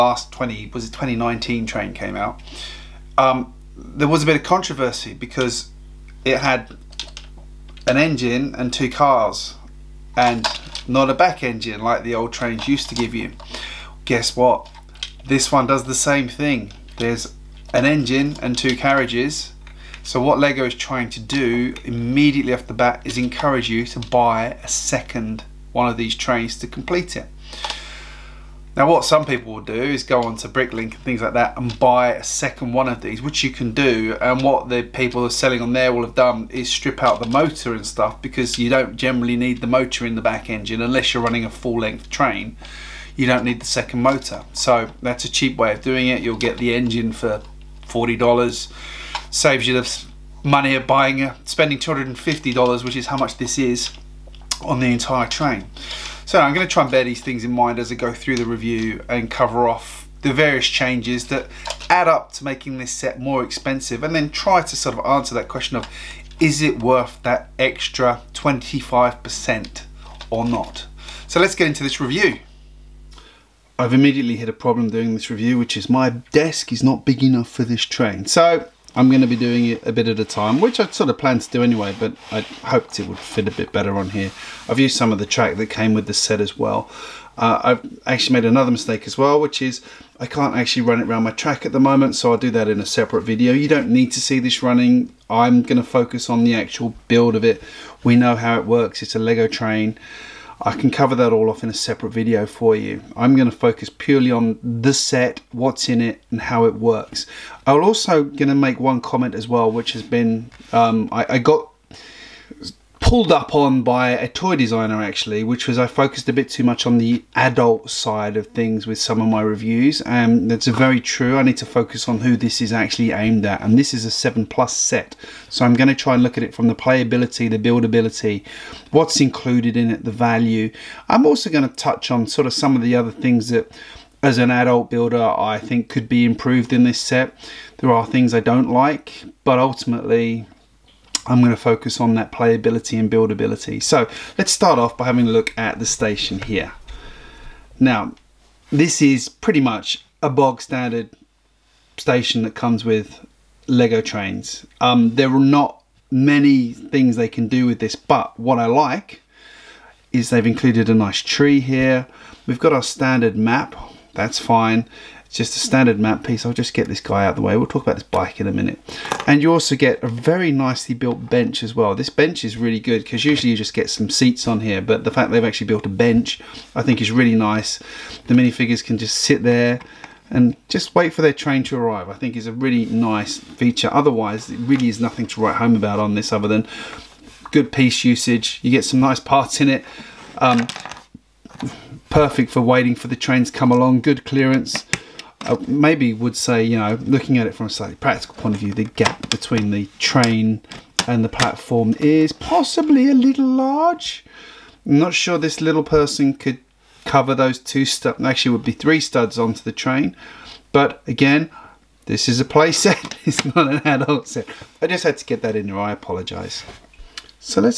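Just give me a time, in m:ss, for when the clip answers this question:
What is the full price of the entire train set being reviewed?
0:51.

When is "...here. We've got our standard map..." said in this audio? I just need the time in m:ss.
2:41.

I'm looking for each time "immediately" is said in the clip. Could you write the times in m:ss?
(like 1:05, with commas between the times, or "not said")
0:21, 1:13.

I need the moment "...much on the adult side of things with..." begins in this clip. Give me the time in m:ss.
1:56.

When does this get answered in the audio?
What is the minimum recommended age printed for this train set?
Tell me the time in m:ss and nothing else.
2:04.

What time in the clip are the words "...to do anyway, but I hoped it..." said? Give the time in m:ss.
1:21.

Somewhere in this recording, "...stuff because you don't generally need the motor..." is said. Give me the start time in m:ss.
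0:37.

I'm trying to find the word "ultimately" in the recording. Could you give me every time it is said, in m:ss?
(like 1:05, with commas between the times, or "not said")
2:19.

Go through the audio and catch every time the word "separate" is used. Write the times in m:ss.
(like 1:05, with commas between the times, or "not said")
1:32, 1:41.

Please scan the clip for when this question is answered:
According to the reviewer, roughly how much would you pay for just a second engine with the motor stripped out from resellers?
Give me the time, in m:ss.
0:47.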